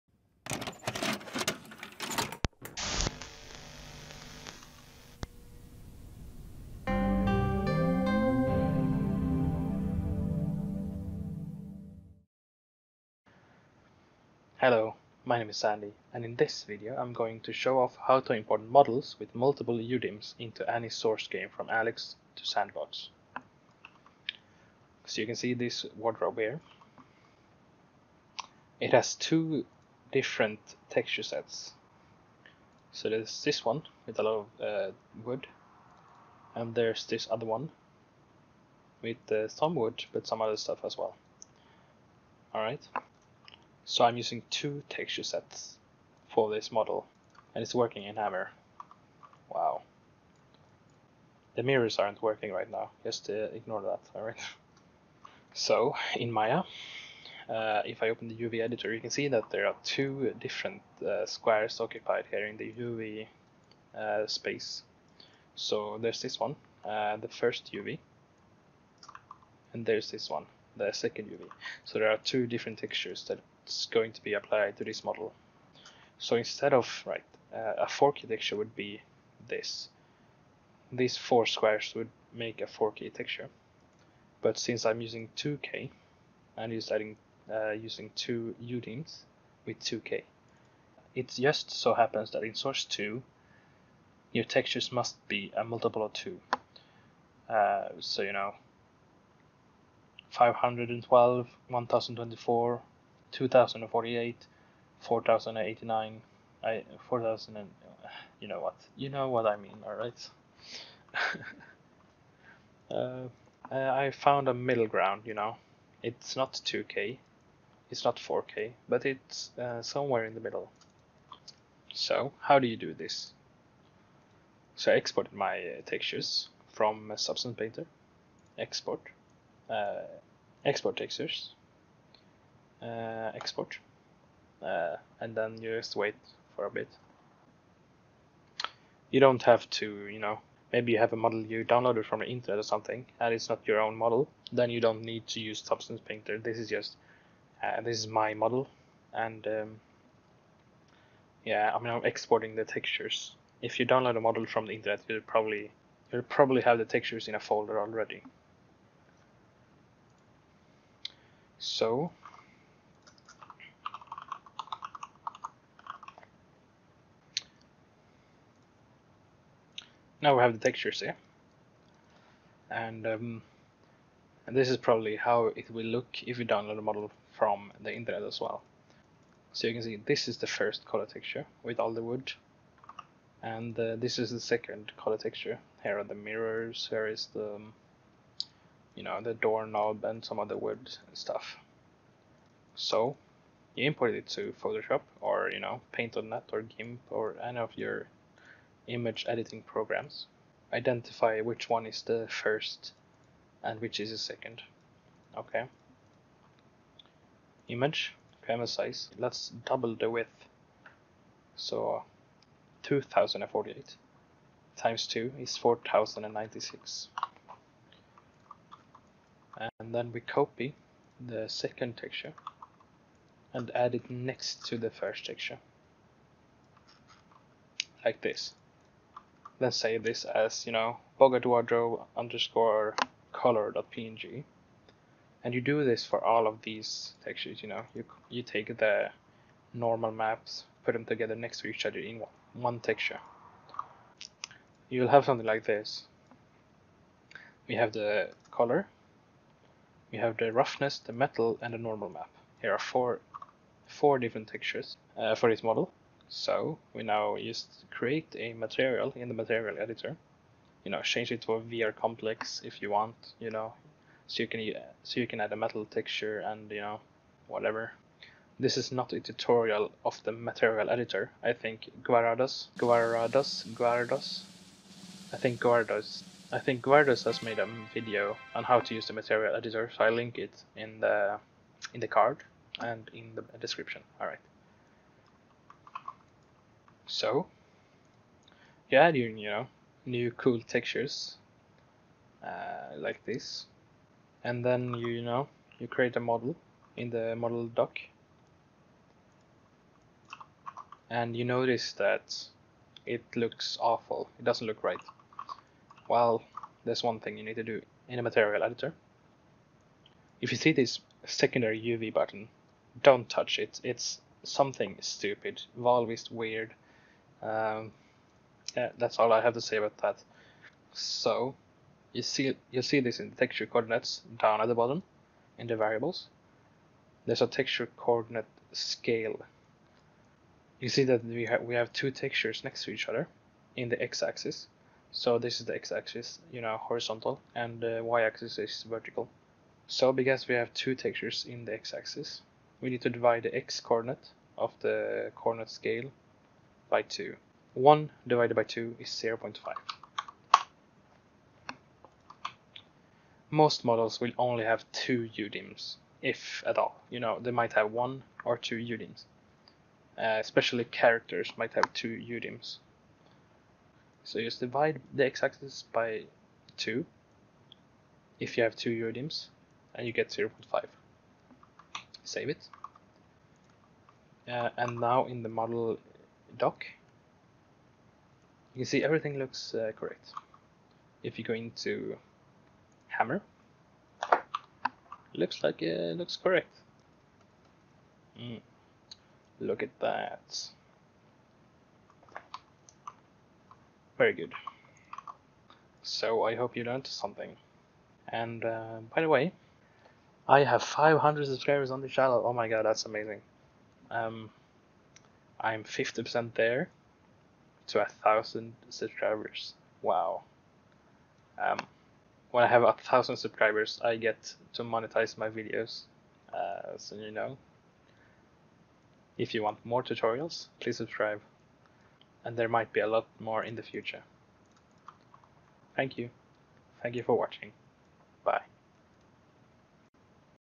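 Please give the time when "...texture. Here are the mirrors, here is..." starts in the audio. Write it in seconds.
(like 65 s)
185 s.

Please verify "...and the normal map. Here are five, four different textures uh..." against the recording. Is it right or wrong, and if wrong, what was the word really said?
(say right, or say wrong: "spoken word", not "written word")
wrong: "four", not "five".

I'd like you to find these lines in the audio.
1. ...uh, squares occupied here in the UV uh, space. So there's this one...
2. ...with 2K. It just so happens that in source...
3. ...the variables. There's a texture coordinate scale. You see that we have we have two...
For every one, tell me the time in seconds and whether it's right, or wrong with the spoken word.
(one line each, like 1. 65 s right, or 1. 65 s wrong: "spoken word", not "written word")
1. 61 s right
2. 89 s right
3. 325 s right.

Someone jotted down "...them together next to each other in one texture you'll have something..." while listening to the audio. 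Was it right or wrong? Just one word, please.
right.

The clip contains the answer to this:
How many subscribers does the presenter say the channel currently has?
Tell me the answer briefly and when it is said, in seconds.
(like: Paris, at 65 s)
500, at 400 s.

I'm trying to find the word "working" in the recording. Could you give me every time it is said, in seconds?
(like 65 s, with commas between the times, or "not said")
47 s, 52 s.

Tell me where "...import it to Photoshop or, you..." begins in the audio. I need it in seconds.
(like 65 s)
193 s.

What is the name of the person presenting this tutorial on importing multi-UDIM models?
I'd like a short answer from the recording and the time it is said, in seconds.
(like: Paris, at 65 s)
Saandy, at 15 s.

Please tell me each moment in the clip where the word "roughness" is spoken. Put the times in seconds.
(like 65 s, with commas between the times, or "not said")
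250 s.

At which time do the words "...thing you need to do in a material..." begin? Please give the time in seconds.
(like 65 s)
307 s.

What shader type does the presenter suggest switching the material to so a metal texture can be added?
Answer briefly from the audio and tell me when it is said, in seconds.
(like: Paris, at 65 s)
VR complex, at 261 s.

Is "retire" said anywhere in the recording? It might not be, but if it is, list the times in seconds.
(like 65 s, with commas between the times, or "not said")
not said.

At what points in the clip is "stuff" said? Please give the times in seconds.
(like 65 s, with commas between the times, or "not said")
40 s, 191 s.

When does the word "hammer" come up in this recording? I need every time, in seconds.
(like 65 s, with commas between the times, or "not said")
48 s, 383 s.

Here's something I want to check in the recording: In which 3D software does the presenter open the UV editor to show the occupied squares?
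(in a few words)
Maya.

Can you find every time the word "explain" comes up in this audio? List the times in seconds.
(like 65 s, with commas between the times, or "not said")
not said.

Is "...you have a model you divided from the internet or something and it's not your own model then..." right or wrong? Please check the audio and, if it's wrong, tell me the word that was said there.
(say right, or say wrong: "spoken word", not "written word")
wrong: "downloaded", not "divided".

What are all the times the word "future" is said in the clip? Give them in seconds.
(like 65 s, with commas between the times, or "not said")
423 s.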